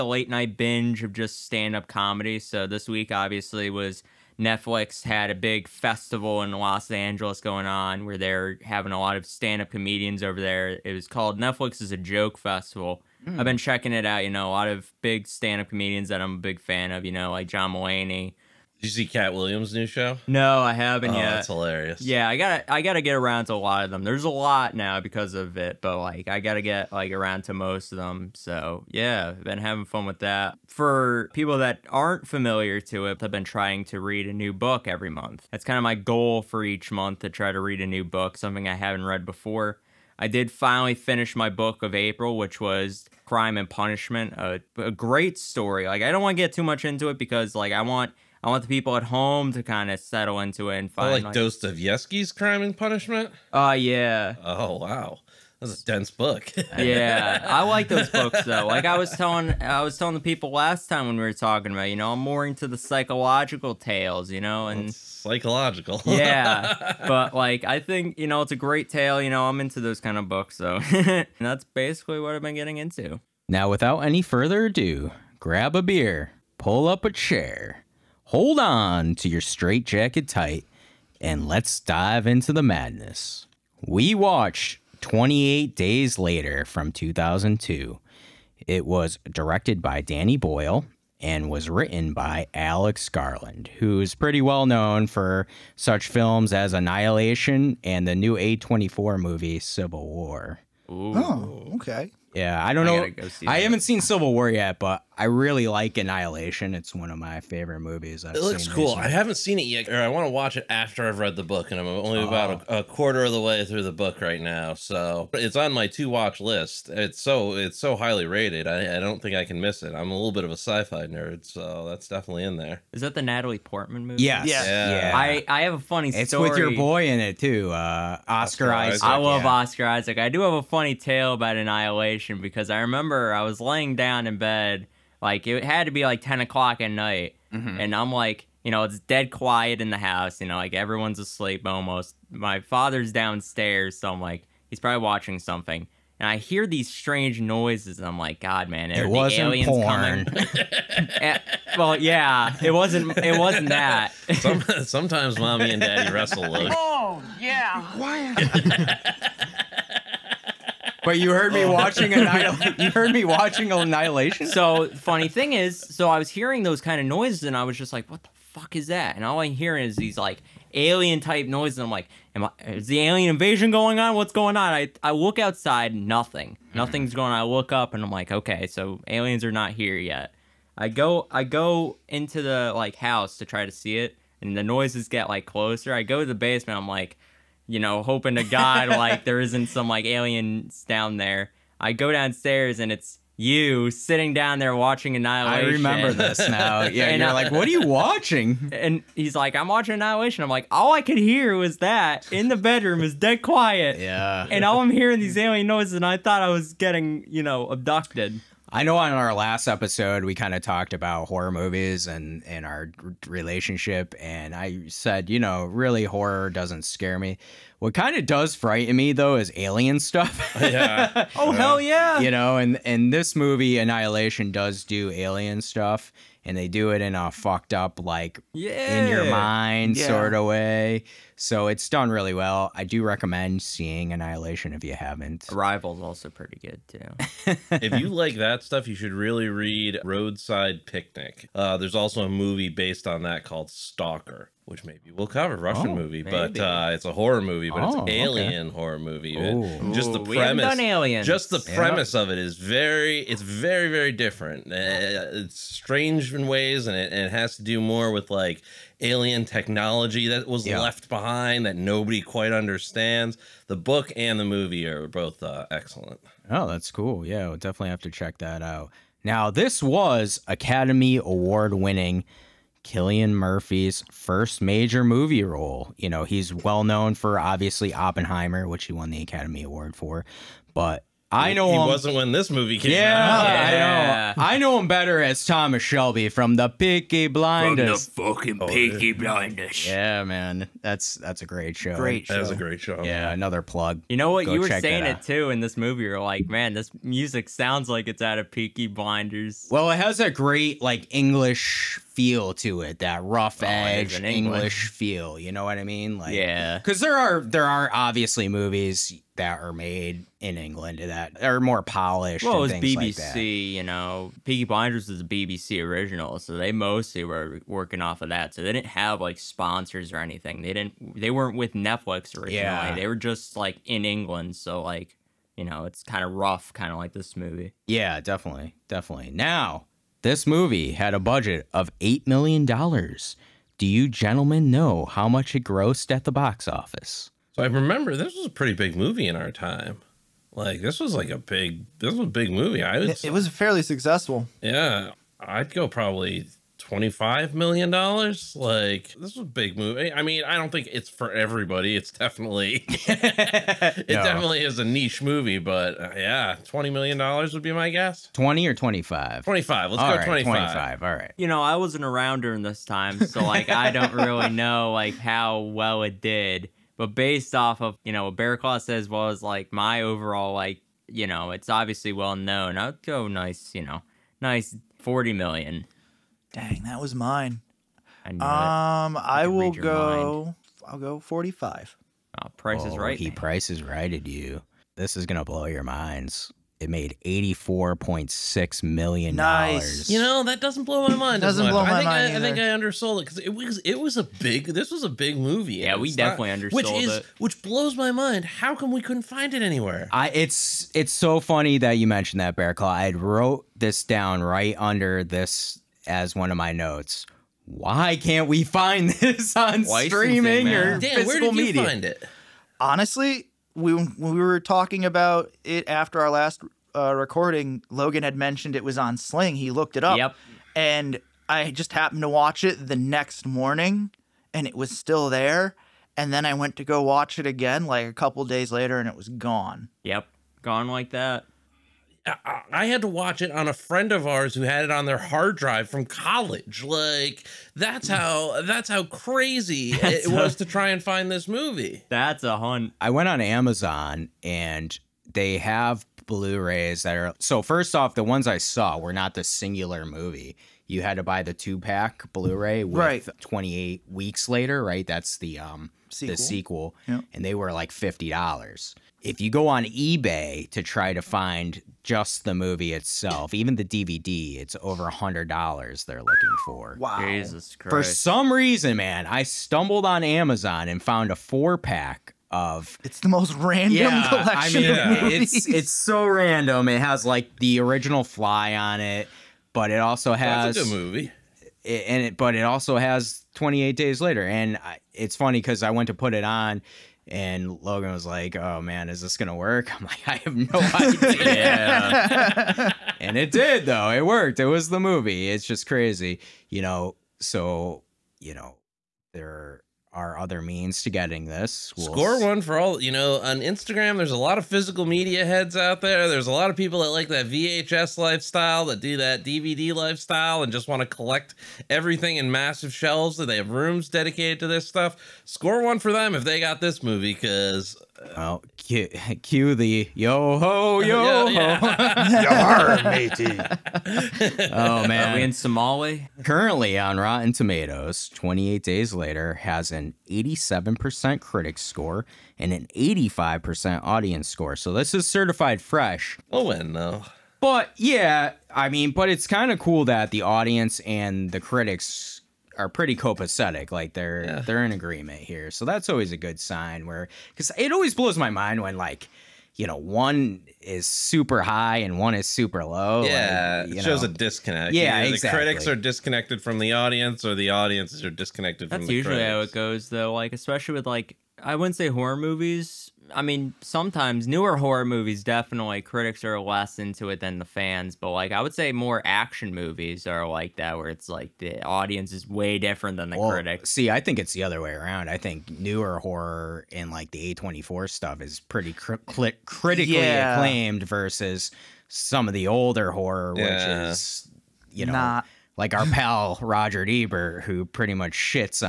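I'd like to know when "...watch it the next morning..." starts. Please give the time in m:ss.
7:02.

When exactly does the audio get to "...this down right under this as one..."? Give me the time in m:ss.
6:43.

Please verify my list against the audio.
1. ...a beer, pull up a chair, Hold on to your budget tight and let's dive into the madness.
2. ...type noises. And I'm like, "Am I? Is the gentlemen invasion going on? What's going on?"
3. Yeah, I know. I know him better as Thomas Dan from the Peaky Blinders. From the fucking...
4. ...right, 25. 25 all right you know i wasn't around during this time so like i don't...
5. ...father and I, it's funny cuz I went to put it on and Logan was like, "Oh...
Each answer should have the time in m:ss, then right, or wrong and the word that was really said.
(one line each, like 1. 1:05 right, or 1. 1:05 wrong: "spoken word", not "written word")
1. 1:15 wrong: "straitjacket", not "budget"
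2. 2:51 wrong: "alien", not "gentlemen"
3. 4:43 wrong: "Shelby", not "Dan"
4. 6:00 right
5. 8:04 wrong: "later", not "father".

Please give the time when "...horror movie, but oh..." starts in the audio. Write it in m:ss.
4:07.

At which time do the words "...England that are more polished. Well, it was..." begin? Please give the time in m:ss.
5:10.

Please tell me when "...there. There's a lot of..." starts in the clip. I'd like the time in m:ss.
8:26.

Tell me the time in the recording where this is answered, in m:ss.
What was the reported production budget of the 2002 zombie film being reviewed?
5:31.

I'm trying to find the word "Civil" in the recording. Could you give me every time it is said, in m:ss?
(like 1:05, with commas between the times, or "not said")
1:39, 1:43.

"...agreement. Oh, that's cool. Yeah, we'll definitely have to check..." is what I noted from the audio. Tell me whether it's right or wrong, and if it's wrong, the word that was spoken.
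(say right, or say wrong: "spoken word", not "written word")
wrong: "excellent", not "agreement".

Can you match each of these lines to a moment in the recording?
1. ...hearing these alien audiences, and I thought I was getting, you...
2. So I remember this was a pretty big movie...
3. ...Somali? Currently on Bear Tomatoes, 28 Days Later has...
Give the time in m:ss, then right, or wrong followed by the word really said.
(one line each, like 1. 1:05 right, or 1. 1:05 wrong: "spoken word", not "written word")
1. 3:24 wrong: "noises", not "audiences"
2. 5:37 right
3. 8:45 wrong: "Rotten", not "Bear".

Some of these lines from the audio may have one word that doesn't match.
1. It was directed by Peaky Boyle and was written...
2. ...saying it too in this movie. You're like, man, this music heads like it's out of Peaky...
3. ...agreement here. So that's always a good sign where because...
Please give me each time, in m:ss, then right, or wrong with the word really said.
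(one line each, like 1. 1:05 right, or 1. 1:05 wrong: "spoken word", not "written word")
1. 1:28 wrong: "Danny", not "Peaky"
2. 4:54 wrong: "sounds", not "heads"
3. 9:04 right.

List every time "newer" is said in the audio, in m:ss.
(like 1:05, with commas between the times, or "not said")
9:24, 9:35.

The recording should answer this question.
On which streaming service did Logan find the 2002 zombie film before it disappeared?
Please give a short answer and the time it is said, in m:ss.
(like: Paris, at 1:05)
Sling, at 6:59.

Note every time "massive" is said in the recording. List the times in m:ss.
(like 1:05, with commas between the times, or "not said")
8:32.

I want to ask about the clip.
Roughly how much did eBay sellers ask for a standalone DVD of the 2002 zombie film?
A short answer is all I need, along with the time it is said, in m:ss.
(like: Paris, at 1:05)
over $100, at 7:44.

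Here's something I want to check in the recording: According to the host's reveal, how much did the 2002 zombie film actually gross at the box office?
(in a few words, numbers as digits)
$84.6 million.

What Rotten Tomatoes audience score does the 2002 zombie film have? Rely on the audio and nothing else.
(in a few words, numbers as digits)
85%.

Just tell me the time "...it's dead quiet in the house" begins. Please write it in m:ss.
2:18.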